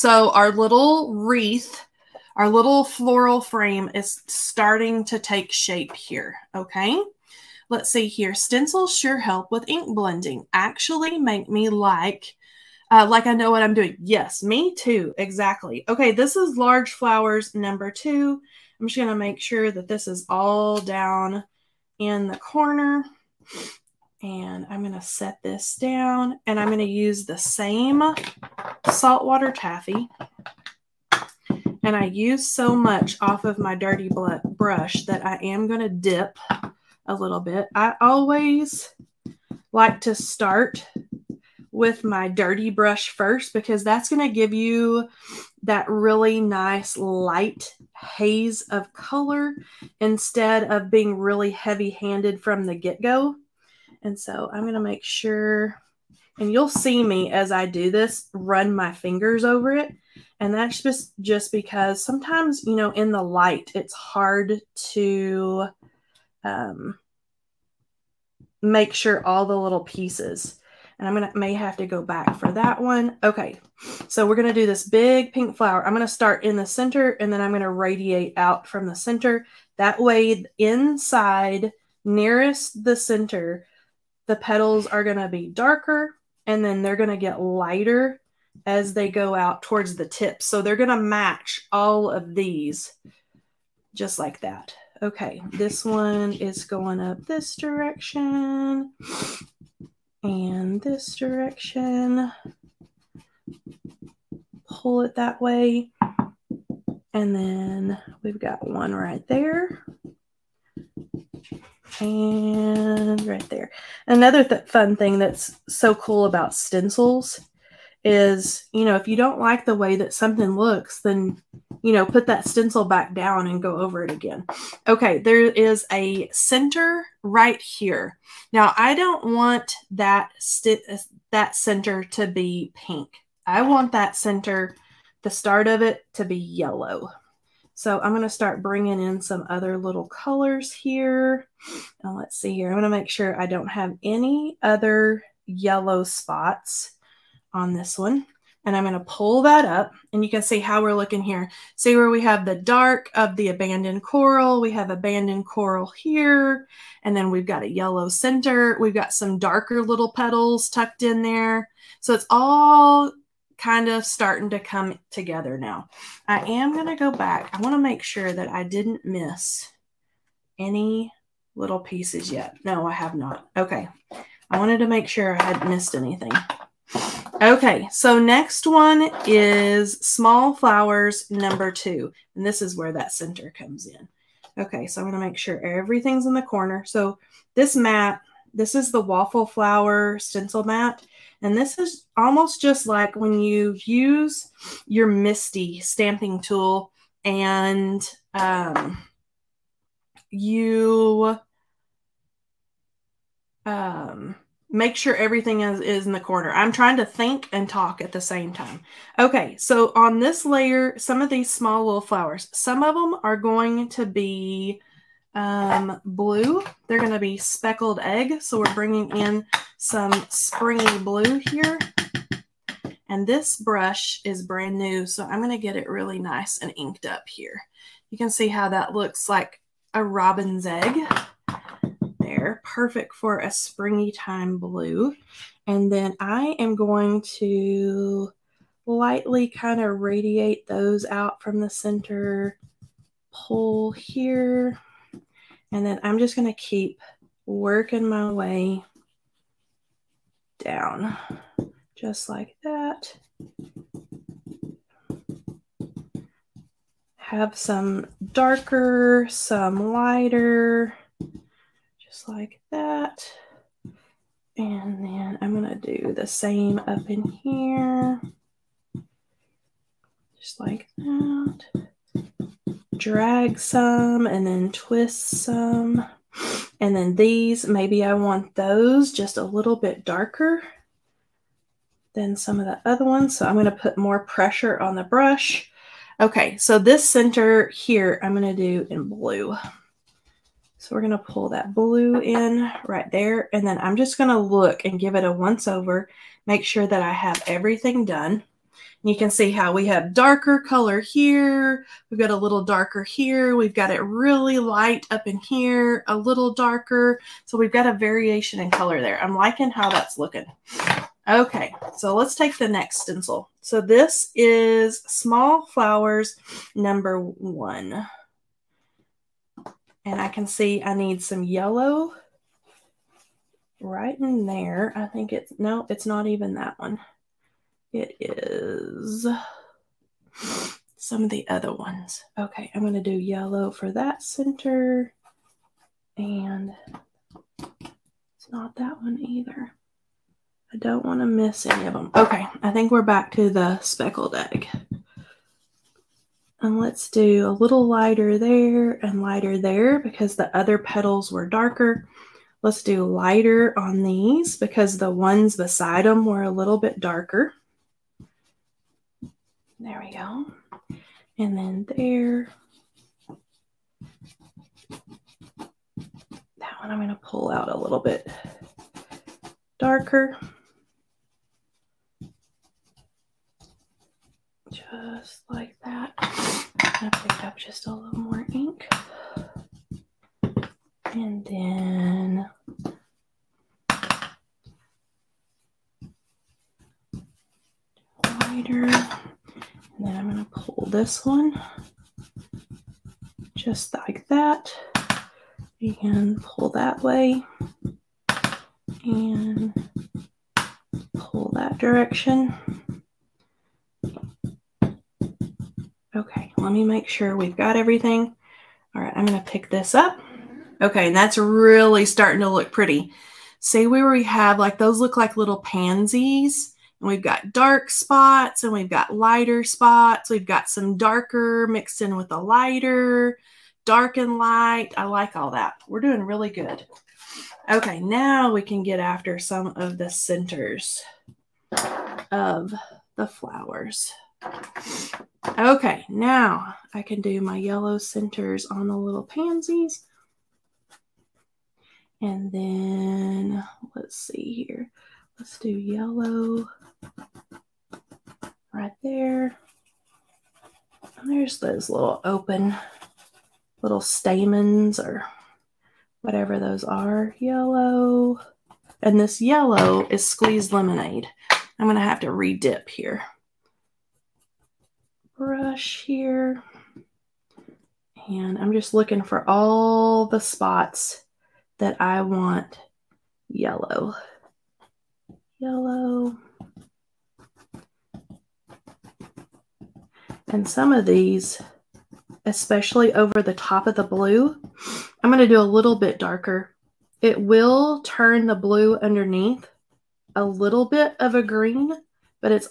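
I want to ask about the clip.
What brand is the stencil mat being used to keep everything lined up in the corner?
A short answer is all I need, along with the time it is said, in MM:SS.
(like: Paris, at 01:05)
Waffle Flower, at 03:08.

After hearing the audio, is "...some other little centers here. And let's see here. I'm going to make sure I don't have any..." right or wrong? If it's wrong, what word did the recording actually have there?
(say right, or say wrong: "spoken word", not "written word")
wrong: "colors", not "centers".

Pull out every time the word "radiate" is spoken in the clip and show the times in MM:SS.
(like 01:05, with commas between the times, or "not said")
01:17, 03:59.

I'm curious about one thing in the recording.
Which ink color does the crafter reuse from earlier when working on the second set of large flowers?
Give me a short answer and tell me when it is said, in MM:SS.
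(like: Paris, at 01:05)
Saltwater Taffy, at 00:28.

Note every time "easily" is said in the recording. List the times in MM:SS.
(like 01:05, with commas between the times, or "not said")
not said.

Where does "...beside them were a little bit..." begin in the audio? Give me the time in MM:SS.
05:55.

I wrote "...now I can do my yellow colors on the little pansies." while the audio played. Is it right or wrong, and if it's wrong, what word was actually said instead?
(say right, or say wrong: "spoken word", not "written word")
wrong: "centers", not "colors".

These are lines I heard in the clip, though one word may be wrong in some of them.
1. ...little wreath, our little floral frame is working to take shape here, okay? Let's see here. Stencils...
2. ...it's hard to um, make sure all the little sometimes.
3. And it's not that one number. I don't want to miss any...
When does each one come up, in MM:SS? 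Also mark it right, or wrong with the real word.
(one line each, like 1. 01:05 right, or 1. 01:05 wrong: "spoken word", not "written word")
1. 00:00 wrong: "starting", not "working"
2. 01:03 wrong: "pieces", not "sometimes"
3. 05:36 wrong: "either", not "number".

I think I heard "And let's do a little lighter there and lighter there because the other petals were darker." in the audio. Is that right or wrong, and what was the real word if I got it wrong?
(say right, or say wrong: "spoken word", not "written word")
right.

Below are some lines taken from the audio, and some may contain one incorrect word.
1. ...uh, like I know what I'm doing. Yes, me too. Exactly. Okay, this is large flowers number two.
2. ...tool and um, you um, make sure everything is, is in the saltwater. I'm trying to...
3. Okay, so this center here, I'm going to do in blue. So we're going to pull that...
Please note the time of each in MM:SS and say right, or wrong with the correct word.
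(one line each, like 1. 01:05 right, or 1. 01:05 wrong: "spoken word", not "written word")
1. 00:12 right
2. 03:16 wrong: "corner", not "saltwater"
3. 04:46 right.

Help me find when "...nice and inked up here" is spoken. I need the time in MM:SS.
03:46.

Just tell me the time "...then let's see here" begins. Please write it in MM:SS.
07:22.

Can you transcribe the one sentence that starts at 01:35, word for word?
Okay, this one is going up this direction and this direction.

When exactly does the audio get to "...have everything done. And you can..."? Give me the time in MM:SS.
04:57.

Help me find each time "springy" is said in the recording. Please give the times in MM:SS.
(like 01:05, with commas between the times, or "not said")
03:40, 03:53.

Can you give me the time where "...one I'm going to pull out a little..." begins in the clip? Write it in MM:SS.
06:06.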